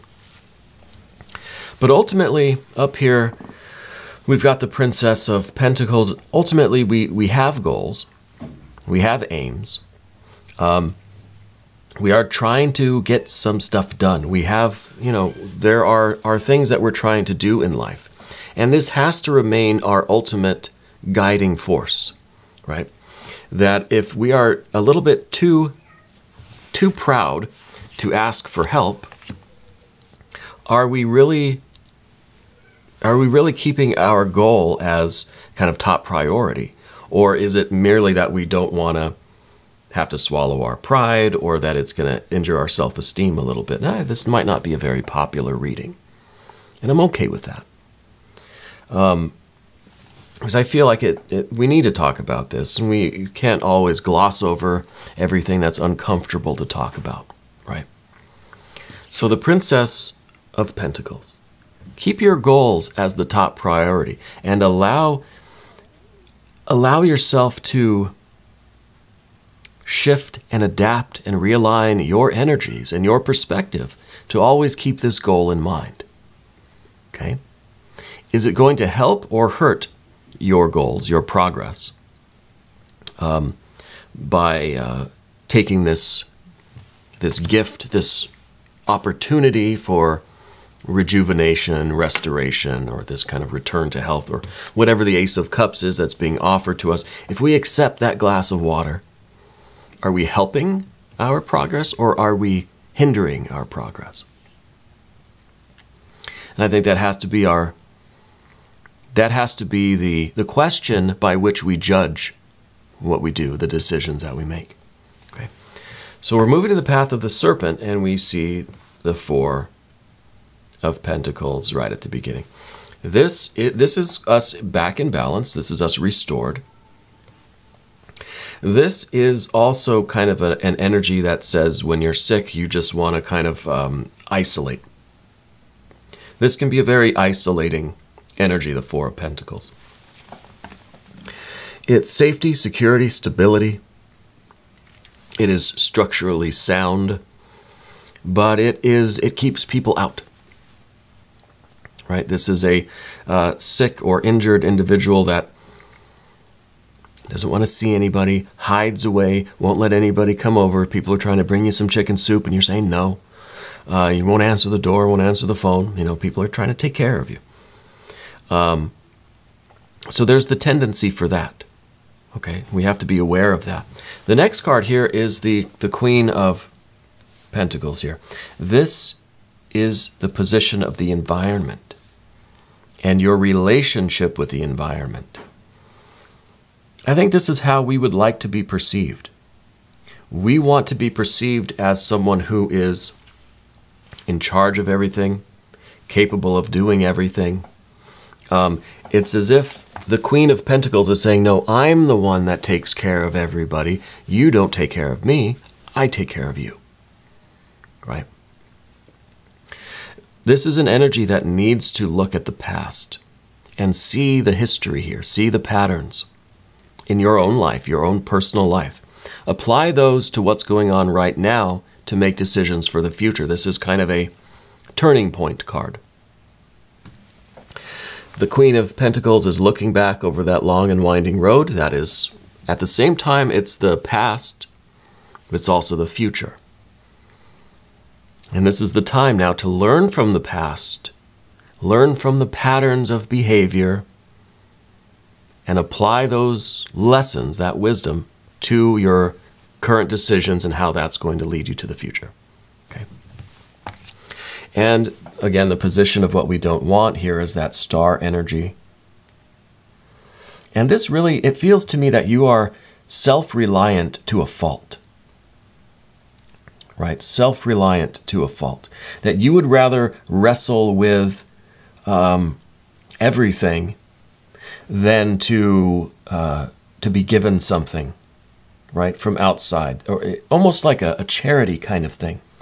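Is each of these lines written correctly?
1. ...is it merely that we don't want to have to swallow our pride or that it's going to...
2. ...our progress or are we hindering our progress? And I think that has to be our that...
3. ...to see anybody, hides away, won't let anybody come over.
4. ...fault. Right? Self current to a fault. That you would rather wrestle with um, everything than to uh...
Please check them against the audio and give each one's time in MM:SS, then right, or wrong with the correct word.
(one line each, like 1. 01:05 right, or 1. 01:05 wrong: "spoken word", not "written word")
1. 00:37 right
2. 01:41 right
3. 02:37 right
4. 04:24 wrong: "reliant", not "current".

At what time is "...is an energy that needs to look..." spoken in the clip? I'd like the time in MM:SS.
03:30.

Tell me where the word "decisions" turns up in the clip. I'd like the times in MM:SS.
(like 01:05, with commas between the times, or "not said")
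01:53, 03:42, 04:10.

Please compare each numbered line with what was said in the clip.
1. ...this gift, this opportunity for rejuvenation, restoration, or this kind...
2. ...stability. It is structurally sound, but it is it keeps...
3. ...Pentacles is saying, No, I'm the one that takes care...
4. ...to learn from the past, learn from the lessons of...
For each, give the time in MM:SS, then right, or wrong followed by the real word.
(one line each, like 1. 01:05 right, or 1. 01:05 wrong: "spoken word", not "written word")
1. 01:27 right
2. 02:23 right
3. 03:20 right
4. 03:59 wrong: "patterns", not "lessons".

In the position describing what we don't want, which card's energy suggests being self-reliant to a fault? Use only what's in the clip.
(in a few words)
Star.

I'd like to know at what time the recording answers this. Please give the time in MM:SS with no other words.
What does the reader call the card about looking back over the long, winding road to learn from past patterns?
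03:44.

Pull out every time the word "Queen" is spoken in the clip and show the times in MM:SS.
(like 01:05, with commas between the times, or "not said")
02:55, 03:20, 03:48.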